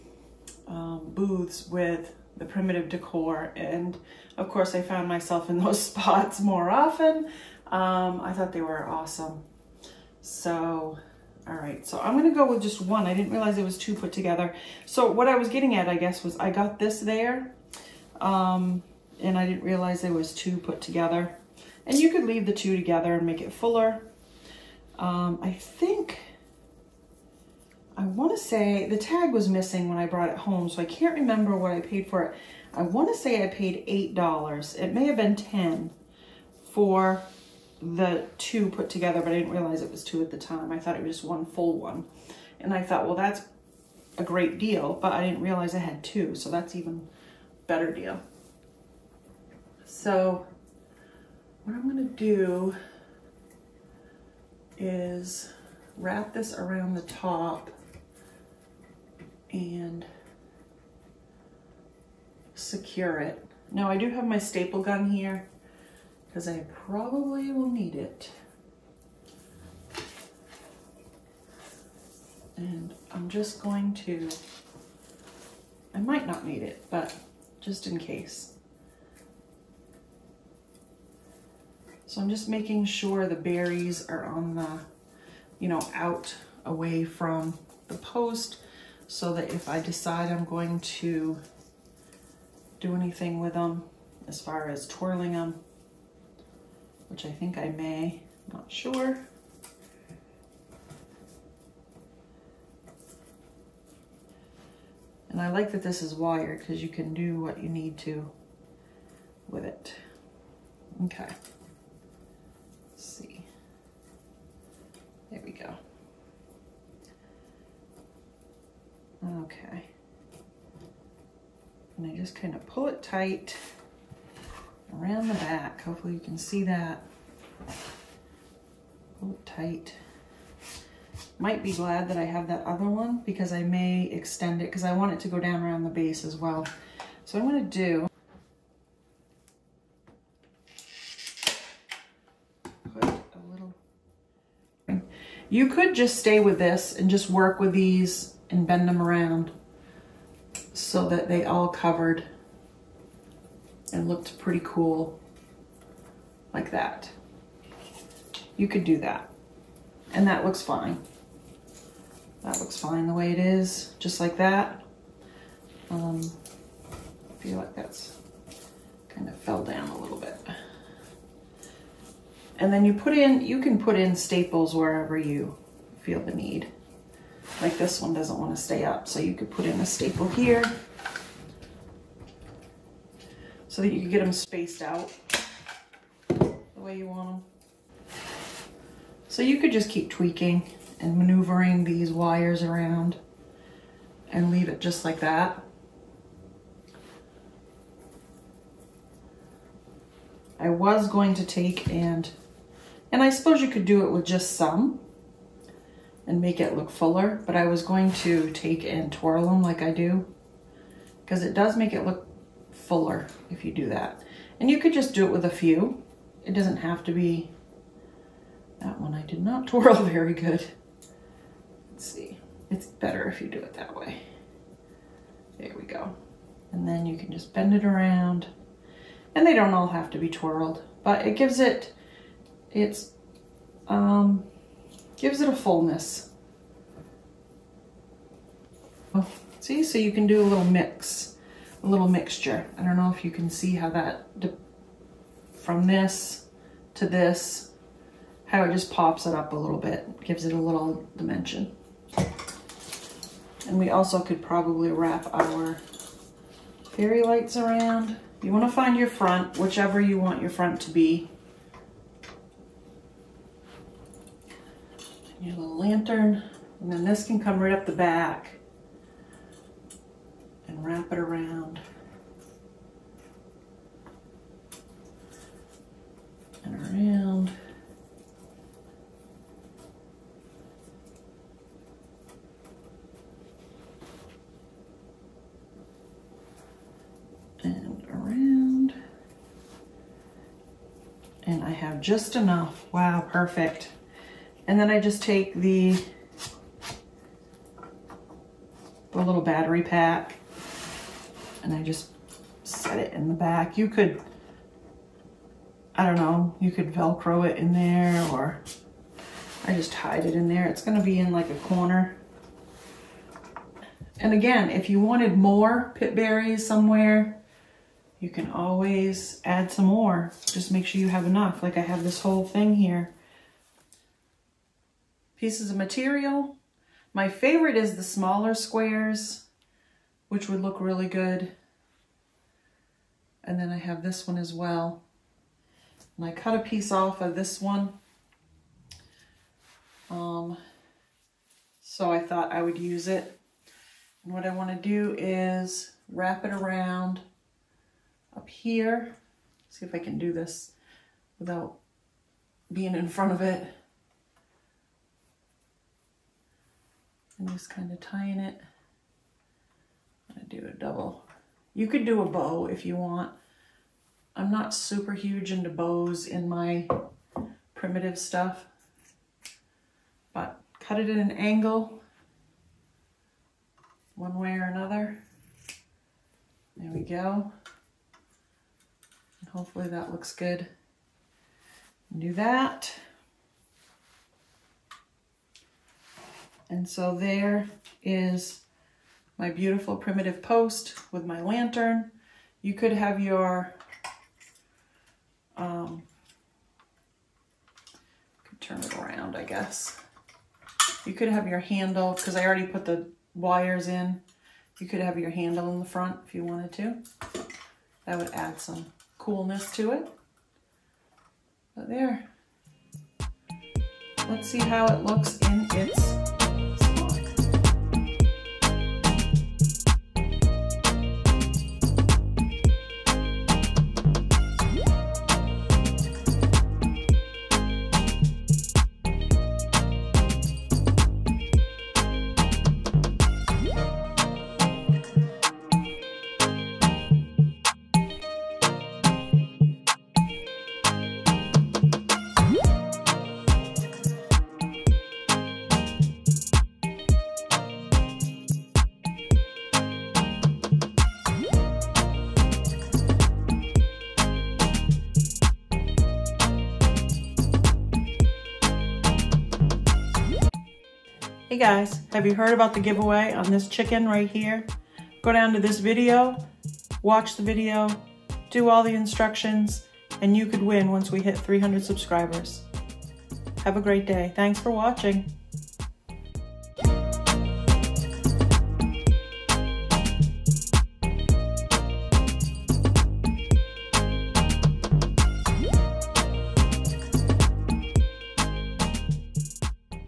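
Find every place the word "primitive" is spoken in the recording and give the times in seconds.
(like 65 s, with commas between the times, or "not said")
2 s, 367 s, 389 s.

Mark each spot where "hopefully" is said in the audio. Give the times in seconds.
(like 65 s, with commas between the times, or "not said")
125 s, 379 s.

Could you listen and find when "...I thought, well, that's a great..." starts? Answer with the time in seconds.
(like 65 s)
42 s.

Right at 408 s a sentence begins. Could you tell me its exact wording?
That would add some coolness to it.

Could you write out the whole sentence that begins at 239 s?
see, so you can do a little mix, a little mixture.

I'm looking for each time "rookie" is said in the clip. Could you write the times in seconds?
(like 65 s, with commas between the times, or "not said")
not said.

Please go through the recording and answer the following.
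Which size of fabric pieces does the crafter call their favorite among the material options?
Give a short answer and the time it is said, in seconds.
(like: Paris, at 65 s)
smaller squares, at 328 s.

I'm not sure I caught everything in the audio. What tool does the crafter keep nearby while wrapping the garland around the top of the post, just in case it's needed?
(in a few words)
staple gun.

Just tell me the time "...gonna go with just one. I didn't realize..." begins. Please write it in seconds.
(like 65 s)
12 s.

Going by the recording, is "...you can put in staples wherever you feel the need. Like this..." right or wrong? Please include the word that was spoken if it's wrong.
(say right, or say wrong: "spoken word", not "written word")
right.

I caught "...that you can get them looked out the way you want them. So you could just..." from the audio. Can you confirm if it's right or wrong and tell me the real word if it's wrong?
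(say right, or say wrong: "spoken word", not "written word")
wrong: "spaced", not "looked".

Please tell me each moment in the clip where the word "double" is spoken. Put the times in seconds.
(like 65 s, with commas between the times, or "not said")
360 s.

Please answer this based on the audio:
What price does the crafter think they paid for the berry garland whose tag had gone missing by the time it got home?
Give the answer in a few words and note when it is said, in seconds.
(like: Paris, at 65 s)
$8, at 34 s.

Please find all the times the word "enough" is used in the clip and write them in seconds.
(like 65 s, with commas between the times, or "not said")
292 s, 321 s.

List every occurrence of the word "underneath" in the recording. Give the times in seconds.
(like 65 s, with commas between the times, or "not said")
not said.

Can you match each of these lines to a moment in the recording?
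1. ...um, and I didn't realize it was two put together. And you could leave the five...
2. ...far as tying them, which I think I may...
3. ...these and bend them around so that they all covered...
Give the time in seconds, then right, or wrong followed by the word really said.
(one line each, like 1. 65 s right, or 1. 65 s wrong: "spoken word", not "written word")
1. 18 s wrong: "two", not "five"
2. 94 s wrong: "twirling", not "tying"
3. 147 s right.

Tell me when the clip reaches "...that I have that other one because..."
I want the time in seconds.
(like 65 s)
132 s.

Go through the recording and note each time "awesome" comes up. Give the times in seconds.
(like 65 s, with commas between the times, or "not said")
8 s.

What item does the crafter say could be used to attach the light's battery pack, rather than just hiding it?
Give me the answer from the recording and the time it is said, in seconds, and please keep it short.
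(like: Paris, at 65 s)
Velcro, at 306 s.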